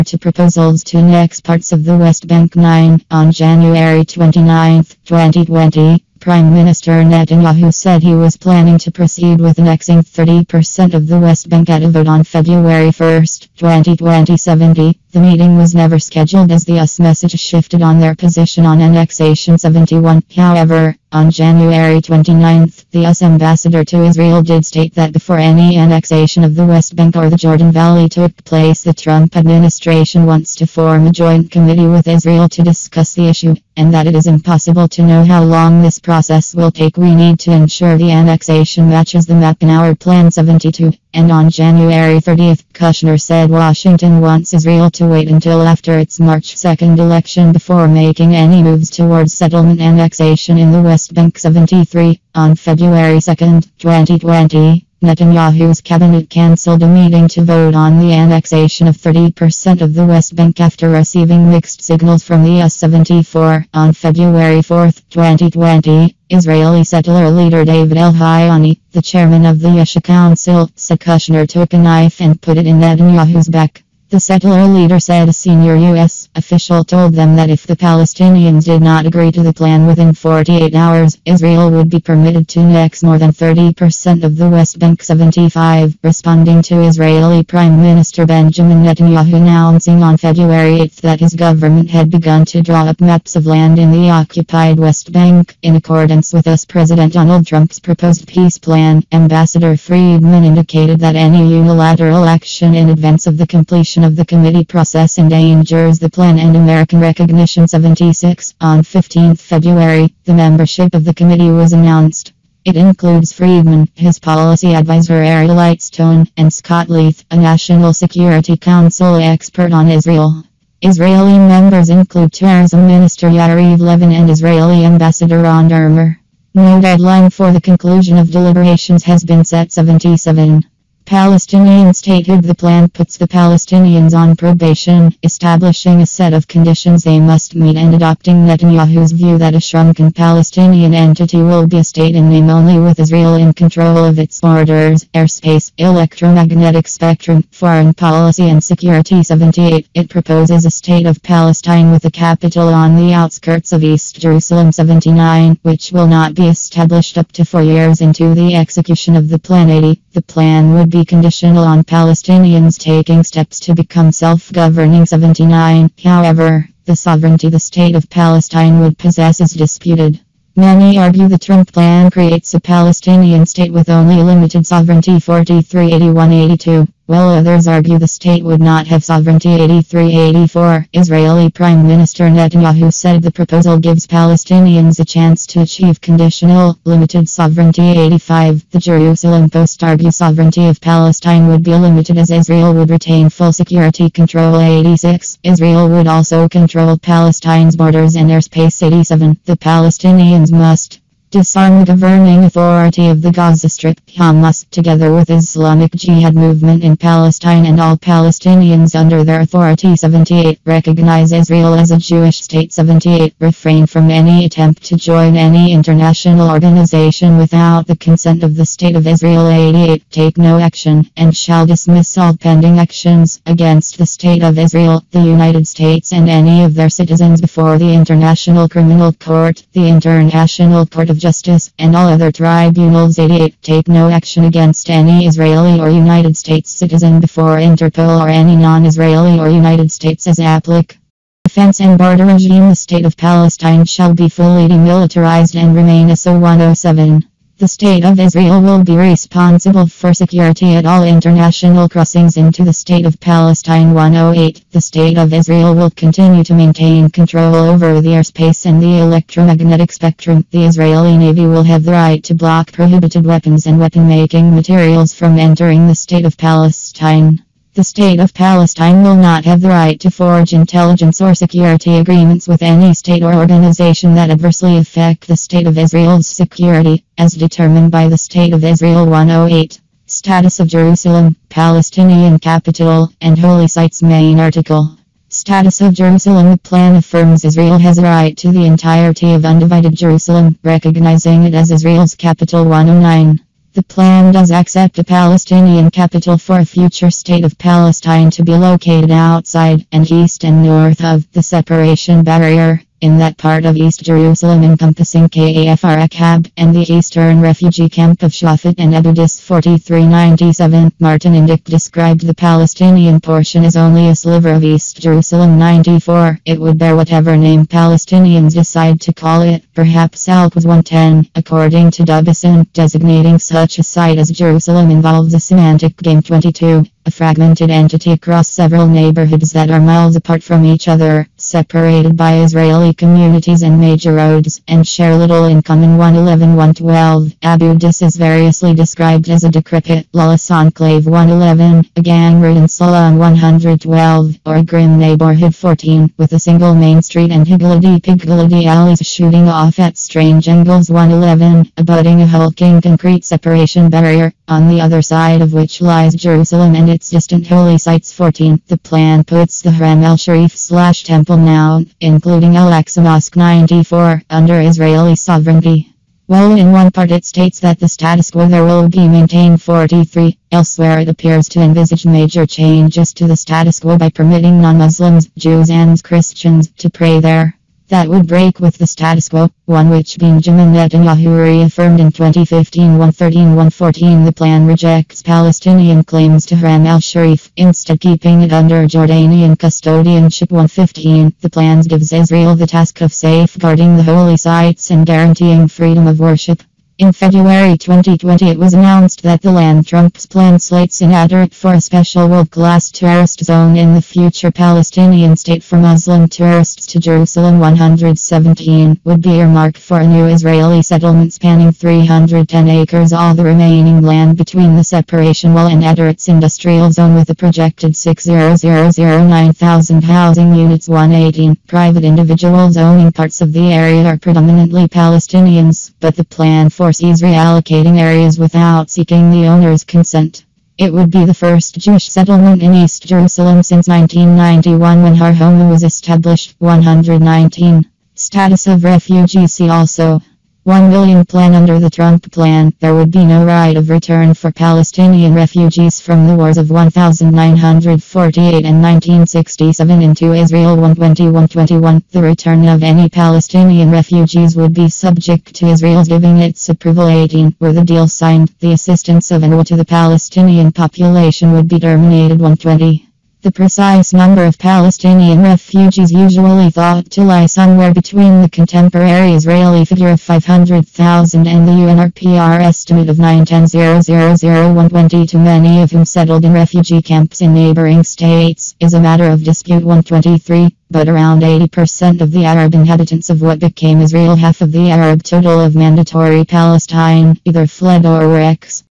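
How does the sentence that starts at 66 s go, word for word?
Israeli settler leader David El-Hayani, the chairman of the Yesha Council, said Kushner took a knife and put it in Netanyahu's back.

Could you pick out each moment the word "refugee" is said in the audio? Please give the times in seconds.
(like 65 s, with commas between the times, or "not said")
307 s, 438 s, 445 s, 453 s, 465 s, 476 s.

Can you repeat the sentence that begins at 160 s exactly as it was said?
The plan would be be conditional on Palestinians taking steps to become self-governing 79.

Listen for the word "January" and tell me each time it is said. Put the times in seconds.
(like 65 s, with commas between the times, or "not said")
3 s, 21 s, 41 s.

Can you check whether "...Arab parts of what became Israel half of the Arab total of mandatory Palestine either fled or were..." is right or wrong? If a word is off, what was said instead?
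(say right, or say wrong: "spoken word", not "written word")
wrong: "inhabitants", not "parts".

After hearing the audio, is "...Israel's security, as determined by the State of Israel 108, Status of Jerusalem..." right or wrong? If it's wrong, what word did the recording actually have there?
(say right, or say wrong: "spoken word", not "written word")
right.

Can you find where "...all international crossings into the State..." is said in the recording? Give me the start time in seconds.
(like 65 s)
250 s.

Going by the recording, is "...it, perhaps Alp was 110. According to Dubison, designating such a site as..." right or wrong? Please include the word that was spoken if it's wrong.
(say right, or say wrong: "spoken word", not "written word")
right.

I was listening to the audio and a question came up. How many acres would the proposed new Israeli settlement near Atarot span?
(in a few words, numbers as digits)
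310 acres.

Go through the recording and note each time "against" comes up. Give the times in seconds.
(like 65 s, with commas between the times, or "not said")
223 s, 234 s.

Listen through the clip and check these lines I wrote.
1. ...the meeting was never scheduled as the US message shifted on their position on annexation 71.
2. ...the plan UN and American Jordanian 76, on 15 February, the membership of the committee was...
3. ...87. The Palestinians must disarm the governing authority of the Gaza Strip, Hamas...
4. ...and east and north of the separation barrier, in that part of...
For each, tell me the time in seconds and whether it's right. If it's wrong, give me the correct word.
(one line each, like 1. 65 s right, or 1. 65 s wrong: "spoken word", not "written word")
1. 15 s right
2. 105 s wrong: "Recognition", not "Jordanian"
3. 198 s right
4. 299 s right.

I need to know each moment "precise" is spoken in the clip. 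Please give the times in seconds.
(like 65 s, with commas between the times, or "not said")
463 s.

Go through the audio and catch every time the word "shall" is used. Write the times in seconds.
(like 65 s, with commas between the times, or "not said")
221 s, 243 s.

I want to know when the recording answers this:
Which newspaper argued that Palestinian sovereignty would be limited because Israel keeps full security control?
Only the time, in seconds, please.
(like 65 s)
188 s.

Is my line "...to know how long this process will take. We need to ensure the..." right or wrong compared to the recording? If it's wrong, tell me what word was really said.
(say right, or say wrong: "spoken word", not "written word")
right.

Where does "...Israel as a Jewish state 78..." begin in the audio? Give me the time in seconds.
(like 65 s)
211 s.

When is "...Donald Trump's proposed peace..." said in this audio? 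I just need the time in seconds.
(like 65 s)
97 s.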